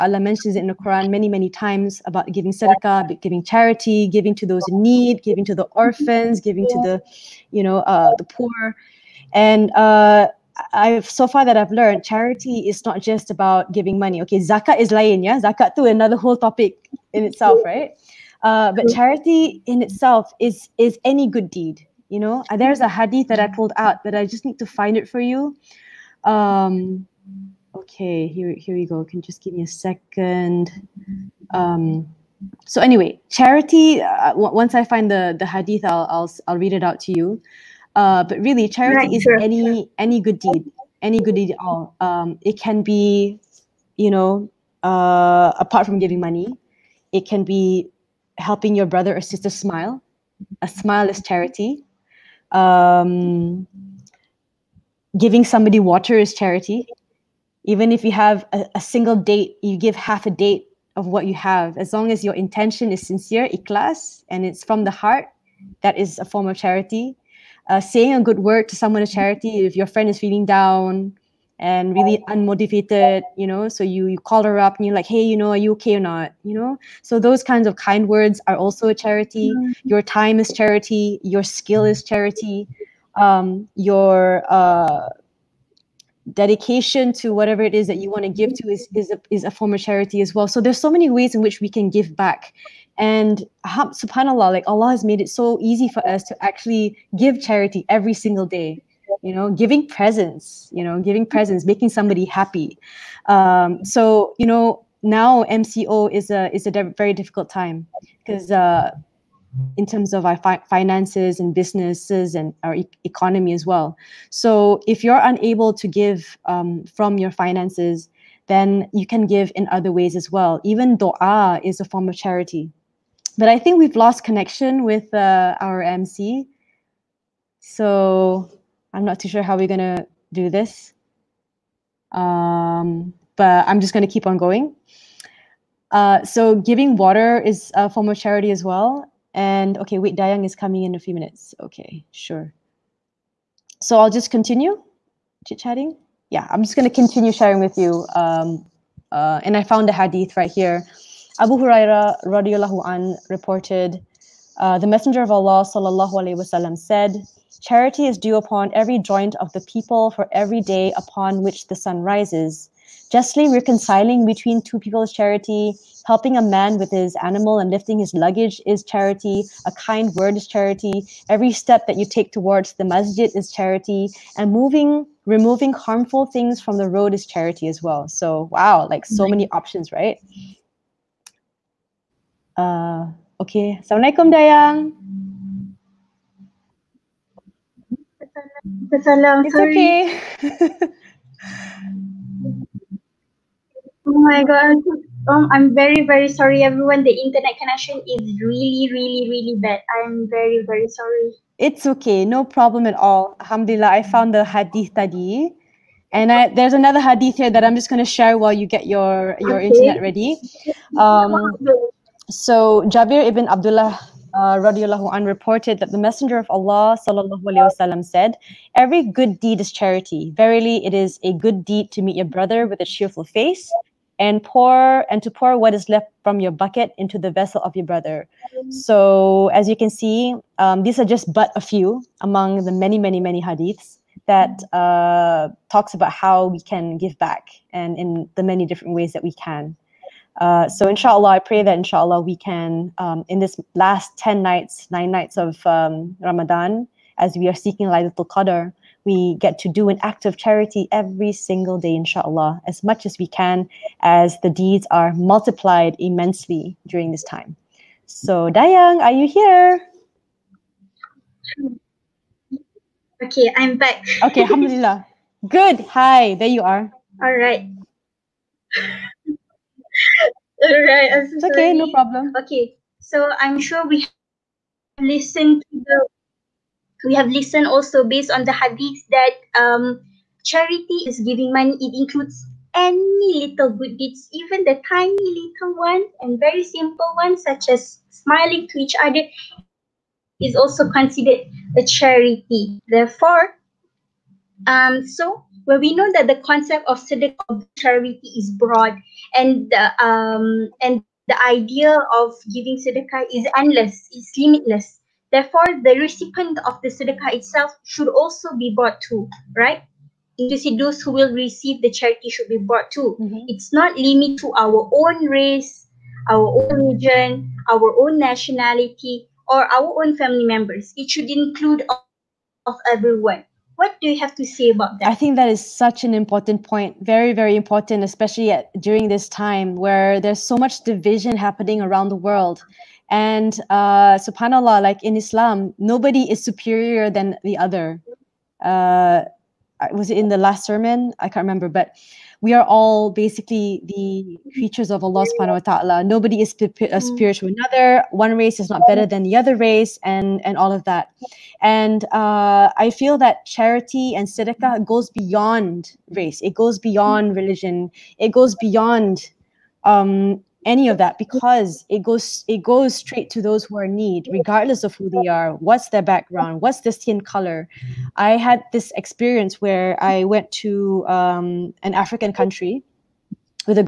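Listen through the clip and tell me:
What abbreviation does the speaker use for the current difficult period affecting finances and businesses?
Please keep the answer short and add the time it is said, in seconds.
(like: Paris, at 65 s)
MCO, at 105 s.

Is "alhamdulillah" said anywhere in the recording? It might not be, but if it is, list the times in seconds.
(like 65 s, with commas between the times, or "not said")
203 s, 264 s.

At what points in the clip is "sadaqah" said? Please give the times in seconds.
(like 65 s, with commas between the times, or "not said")
2 s, 302 s, 306 s, 354 s.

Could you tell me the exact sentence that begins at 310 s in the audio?
You see, those who will receive the charity should be brought to.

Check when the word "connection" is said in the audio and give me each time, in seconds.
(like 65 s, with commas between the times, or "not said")
124 s, 197 s.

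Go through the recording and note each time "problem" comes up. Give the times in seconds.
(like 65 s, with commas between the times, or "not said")
202 s, 271 s.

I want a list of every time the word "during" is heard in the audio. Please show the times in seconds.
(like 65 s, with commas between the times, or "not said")
256 s, 328 s.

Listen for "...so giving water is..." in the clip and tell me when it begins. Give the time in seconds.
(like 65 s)
136 s.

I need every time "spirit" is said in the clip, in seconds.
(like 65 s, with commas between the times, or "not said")
347 s.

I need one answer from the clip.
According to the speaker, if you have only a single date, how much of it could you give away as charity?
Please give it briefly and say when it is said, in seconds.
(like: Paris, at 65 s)
Half a date, at 59 s.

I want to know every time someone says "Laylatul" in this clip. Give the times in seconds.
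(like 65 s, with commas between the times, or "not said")
247 s.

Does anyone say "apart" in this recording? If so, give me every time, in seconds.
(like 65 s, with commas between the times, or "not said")
45 s.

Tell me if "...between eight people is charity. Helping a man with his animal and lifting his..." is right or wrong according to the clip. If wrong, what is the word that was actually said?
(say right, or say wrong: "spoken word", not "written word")
wrong: "two", not "eight".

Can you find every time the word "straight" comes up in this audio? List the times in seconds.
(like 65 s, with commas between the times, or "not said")
362 s.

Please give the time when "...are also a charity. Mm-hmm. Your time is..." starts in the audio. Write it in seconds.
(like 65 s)
78 s.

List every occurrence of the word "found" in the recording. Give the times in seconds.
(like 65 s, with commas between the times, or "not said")
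149 s, 204 s.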